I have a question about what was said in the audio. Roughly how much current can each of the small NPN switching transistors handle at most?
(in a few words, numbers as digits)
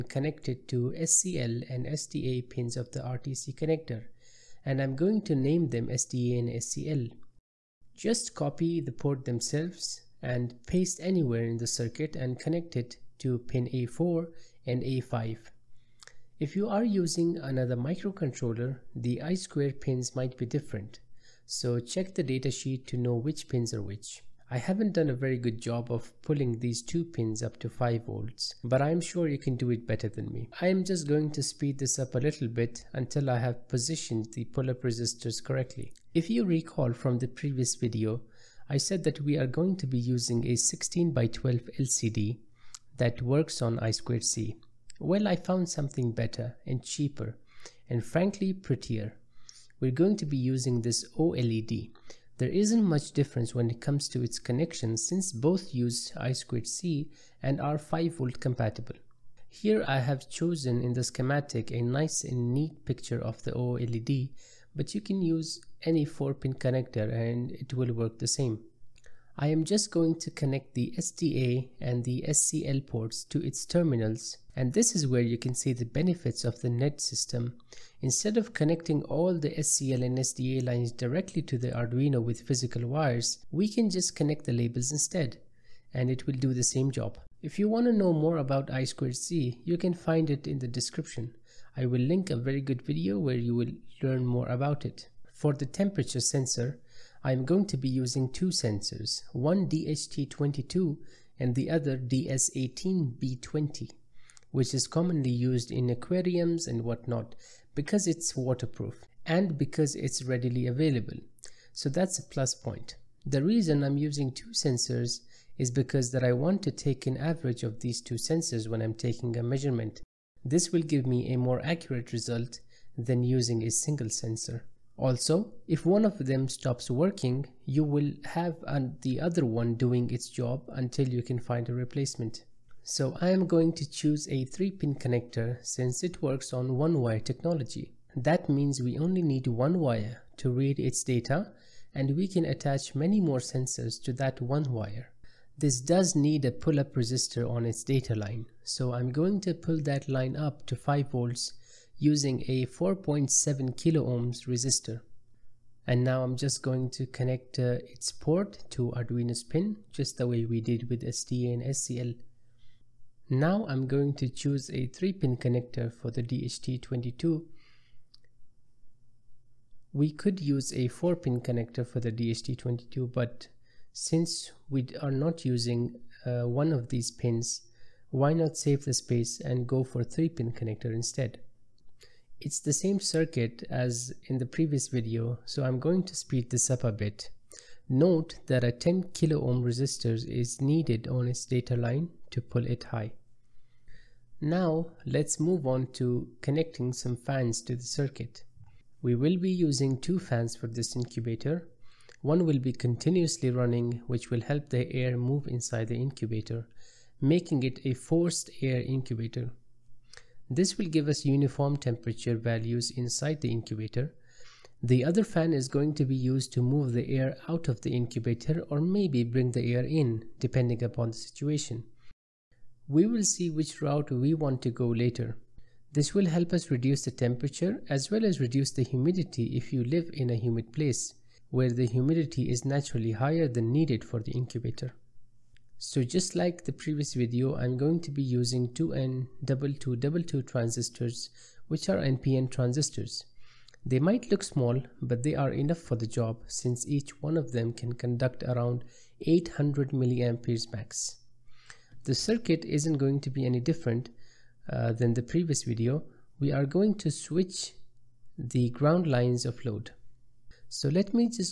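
800 milliamperes.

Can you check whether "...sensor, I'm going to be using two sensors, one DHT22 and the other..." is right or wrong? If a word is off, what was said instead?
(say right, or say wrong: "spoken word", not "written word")
right.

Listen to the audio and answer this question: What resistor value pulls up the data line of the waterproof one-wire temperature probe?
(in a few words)
4.7 kilo ohms.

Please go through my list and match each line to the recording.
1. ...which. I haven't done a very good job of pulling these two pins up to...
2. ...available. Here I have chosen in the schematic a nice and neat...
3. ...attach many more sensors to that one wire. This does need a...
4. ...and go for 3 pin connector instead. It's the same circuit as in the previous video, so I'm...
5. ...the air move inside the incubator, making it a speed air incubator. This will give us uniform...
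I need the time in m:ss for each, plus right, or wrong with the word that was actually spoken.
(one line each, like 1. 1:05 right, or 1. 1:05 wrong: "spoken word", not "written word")
1. 0:23 right
2. 0:58 wrong: "compatible", not "available"
3. 2:22 right
4. 2:59 right
5. 3:24 wrong: "forced", not "speed".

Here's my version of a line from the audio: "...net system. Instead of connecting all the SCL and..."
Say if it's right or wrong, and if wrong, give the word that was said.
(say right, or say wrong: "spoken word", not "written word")
right.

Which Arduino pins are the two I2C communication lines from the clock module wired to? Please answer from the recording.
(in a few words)
A4 and A5.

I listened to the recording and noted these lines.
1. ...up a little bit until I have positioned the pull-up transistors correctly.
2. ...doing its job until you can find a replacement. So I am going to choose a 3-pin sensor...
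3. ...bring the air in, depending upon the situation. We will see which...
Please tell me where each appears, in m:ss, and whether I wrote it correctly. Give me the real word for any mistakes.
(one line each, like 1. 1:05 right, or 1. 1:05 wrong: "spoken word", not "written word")
1. 0:31 wrong: "resistors", not "transistors"
2. 2:09 wrong: "connector", not "sensor"
3. 3:39 right.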